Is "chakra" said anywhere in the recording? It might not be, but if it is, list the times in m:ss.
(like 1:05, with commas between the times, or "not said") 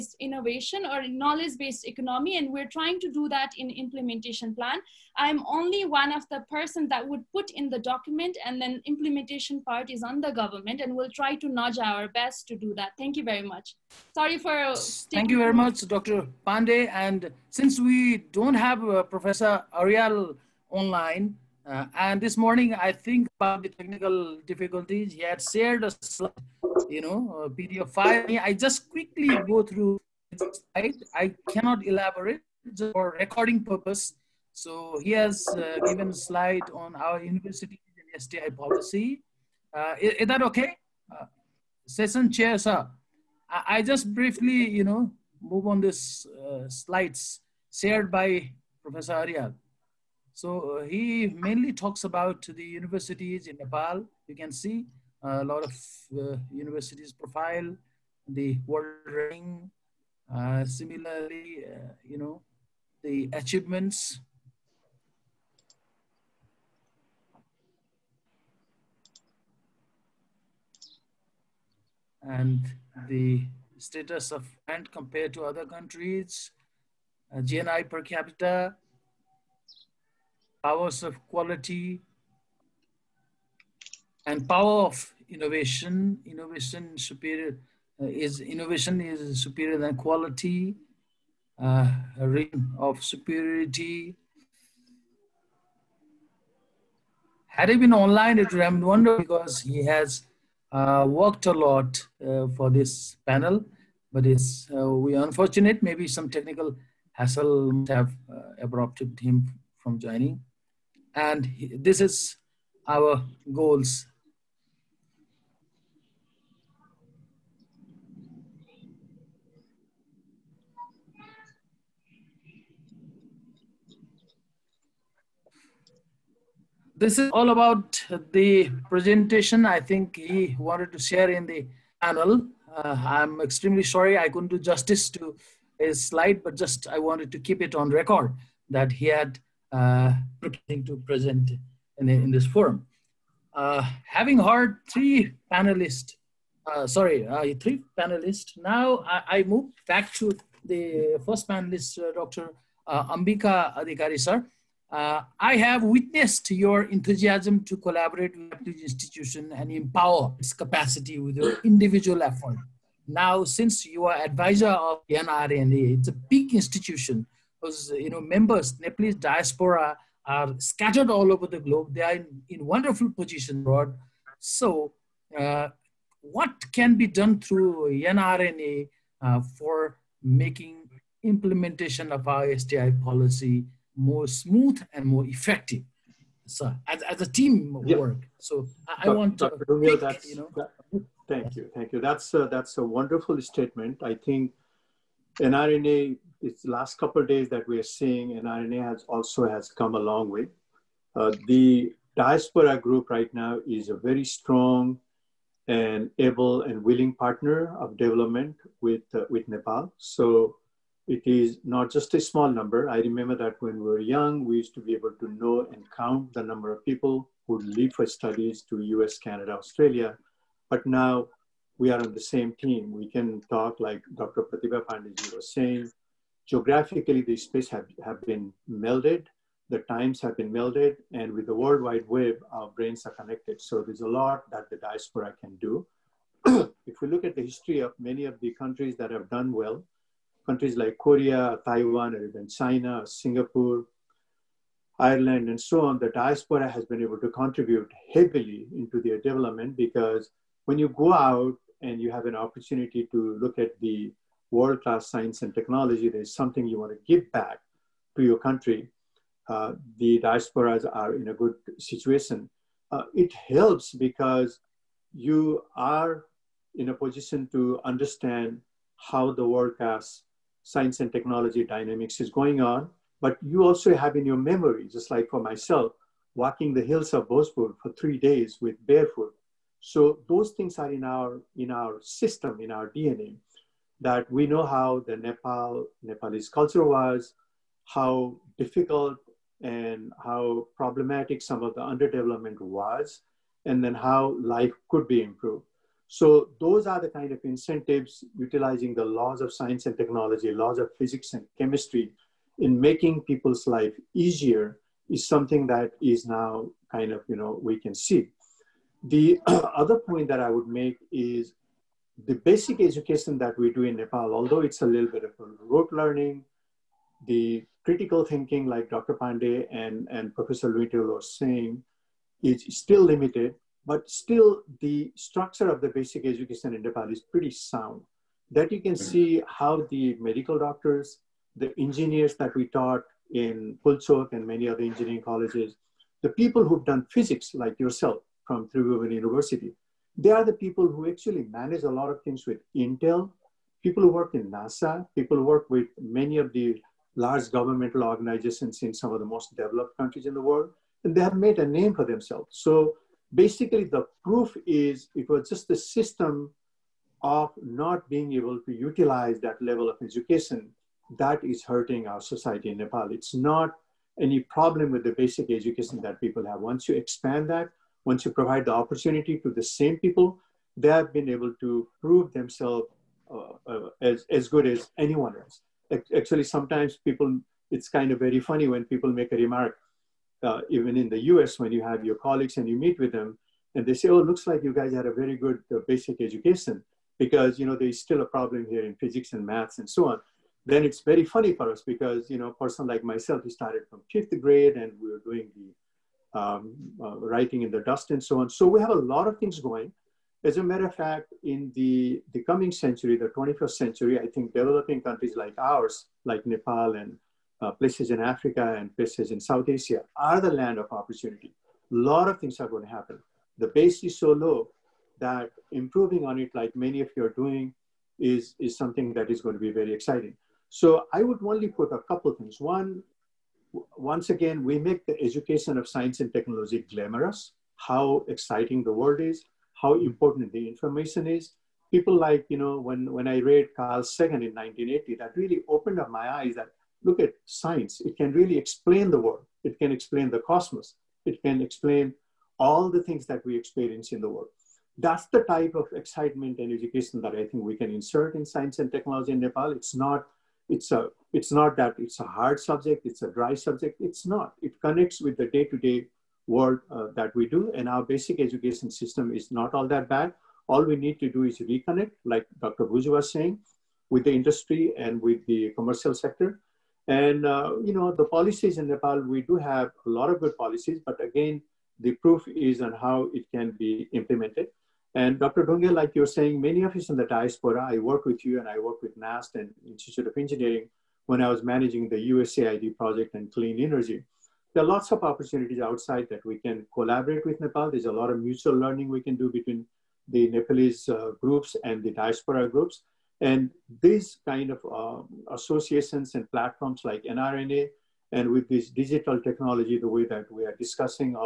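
not said.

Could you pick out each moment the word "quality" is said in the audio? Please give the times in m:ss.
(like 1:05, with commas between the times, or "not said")
1:21, 1:29.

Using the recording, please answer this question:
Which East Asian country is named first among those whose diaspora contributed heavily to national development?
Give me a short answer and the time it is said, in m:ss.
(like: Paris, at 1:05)
Korea, at 4:00.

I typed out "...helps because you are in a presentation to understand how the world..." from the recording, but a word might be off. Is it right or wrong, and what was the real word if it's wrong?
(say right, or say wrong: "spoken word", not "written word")
wrong: "position", not "presentation".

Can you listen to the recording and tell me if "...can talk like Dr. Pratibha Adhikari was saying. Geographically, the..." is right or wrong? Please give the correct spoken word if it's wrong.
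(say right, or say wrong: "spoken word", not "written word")
wrong: "Pandey", not "Adhikari".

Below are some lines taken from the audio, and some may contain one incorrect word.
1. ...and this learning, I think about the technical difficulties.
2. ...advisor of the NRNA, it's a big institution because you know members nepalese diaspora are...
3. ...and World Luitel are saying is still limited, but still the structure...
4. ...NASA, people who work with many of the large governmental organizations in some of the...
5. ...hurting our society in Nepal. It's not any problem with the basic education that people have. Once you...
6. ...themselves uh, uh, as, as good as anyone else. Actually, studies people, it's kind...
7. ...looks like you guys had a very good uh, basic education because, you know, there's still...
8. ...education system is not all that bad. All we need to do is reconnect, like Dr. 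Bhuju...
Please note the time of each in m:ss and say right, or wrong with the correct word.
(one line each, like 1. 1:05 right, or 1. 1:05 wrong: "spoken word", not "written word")
1. 0:21 wrong: "morning", not "learning"
2. 2:44 right
3. 5:20 wrong: "Professor", not "World"
4. 5:44 right
5. 6:01 right
6. 6:12 wrong: "sometimes", not "studies"
7. 6:24 right
8. 7:38 right.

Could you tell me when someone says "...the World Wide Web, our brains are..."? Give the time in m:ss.
3:51.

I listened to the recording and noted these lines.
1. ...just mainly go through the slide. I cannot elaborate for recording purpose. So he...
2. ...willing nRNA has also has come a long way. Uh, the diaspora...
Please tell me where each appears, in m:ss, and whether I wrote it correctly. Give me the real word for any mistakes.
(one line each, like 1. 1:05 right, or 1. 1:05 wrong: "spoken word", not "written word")
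1. 0:28 wrong: "quickly", not "mainly"
2. 3:17 wrong: "seeing", not "willing".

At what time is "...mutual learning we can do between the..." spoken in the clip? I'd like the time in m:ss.
8:08.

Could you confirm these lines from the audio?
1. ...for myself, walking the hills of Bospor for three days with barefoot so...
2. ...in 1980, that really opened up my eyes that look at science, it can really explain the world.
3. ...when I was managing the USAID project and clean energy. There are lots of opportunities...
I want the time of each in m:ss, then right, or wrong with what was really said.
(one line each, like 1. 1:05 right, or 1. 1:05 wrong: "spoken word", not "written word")
1. 4:35 right
2. 7:14 right
3. 8:01 right.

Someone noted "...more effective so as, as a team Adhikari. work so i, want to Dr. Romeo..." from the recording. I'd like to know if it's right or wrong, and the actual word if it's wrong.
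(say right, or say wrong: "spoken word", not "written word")
wrong: "Yeah", not "Adhikari".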